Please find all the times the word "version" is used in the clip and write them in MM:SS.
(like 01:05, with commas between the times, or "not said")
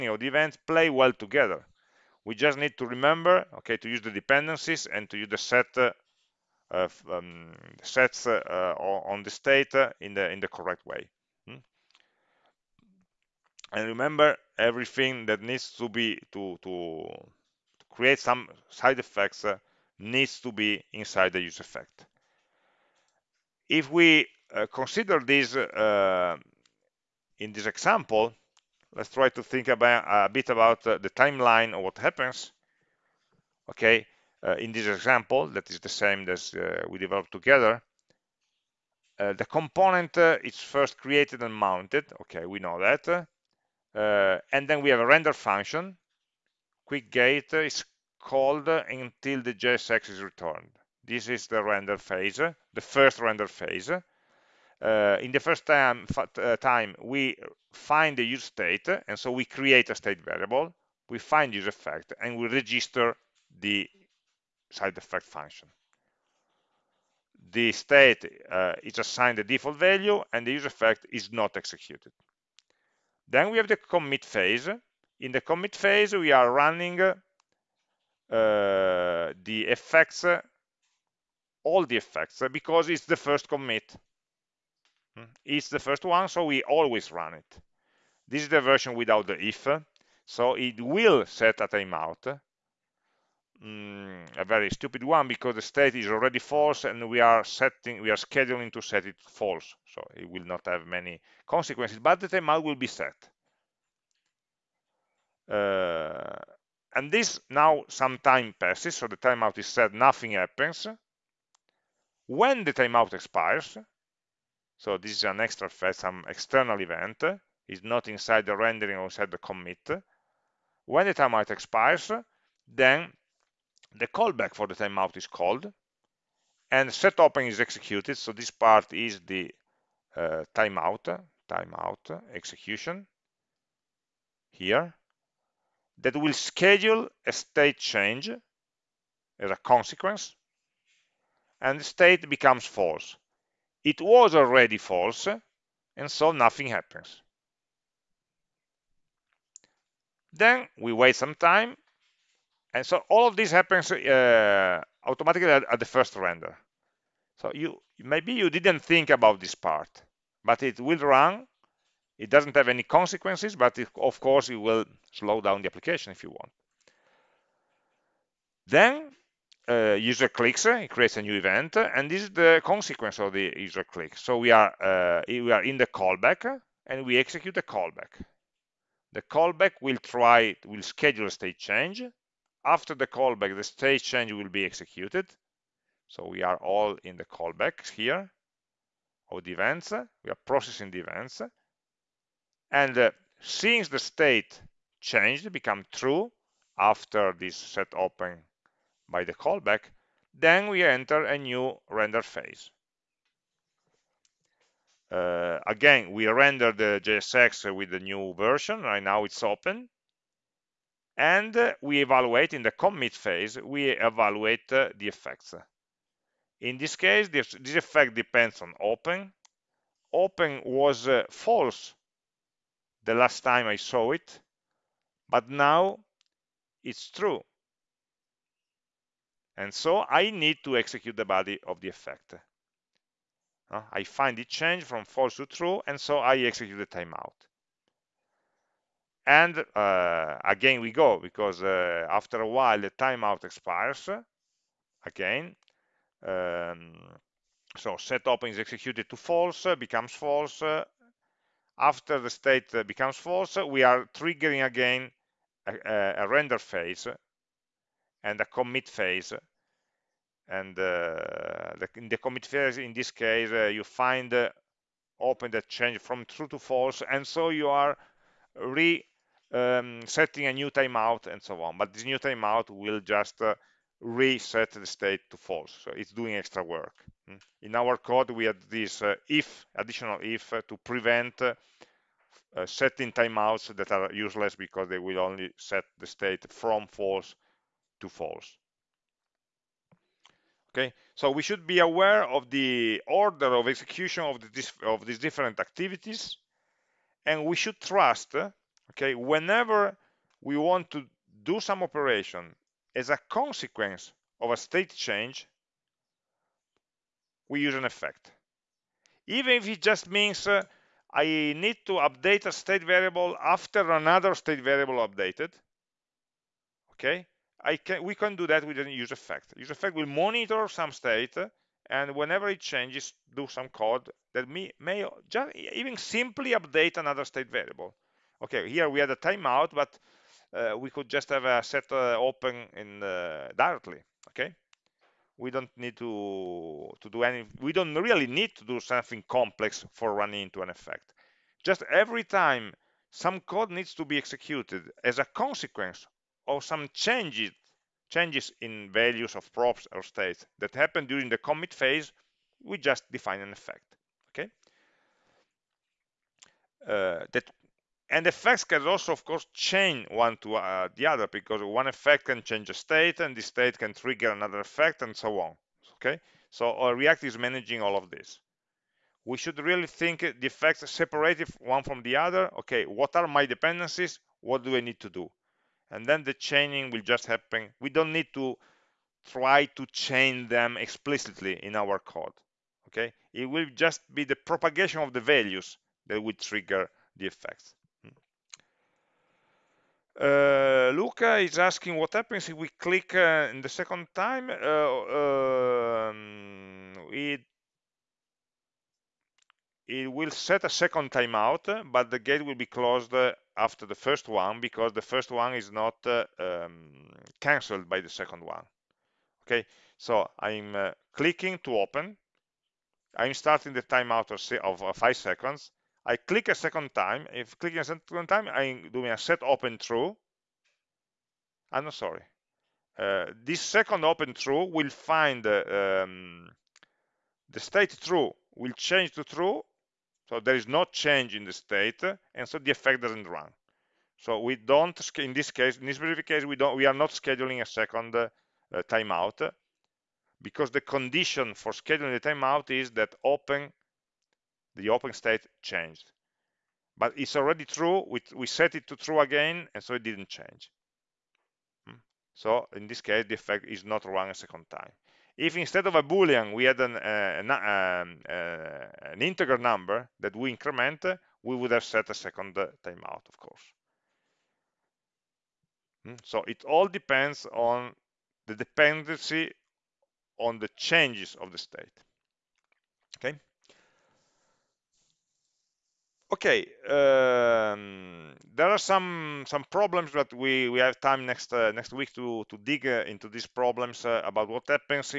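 01:28, 03:28.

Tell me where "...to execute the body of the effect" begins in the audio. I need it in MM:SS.
03:50.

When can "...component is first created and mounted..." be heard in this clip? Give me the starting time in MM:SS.
00:39.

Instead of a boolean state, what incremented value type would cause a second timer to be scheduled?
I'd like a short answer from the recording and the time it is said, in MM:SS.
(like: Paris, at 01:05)
an integer number, at 07:39.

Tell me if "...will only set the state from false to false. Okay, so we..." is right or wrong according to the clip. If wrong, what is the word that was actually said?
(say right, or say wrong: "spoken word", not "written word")
right.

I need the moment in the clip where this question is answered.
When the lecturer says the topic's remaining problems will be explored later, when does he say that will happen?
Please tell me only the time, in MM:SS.
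08:01.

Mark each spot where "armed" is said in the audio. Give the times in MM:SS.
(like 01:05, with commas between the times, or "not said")
not said.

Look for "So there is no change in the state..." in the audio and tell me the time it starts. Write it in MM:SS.
07:10.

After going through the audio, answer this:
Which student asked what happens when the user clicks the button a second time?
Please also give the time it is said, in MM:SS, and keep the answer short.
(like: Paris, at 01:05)
Luca, at 06:30.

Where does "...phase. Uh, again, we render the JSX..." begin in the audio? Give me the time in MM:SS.
03:22.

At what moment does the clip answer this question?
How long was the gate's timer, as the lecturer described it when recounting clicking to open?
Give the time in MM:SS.
06:54.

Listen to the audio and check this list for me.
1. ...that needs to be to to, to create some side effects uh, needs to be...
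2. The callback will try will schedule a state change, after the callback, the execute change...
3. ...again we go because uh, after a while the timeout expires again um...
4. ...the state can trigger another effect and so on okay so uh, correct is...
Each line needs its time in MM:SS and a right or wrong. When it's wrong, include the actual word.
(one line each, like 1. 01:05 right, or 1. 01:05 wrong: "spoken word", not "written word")
1. 00:15 right
2. 02:59 wrong: "state", not "execute"
3. 04:00 right
4. 06:03 wrong: "react", not "correct".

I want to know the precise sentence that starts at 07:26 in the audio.
But it's already true, we, we set it to true again, and so it didn't change.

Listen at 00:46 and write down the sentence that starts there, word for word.
Quick gate is called until the JSX is returned.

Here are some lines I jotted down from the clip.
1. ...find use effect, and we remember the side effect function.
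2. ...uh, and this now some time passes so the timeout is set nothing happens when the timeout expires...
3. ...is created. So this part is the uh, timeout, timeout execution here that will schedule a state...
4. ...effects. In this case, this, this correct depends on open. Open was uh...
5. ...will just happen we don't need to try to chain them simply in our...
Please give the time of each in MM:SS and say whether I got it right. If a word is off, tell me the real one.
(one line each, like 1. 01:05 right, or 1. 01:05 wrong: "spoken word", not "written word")
1. 01:01 wrong: "register", not "remember"
2. 01:45 right
3. 02:07 wrong: "executed", not "created"
4. 03:35 wrong: "effect", not "correct"
5. 06:16 wrong: "explicitly", not "simply".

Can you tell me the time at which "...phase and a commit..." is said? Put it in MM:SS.
04:16.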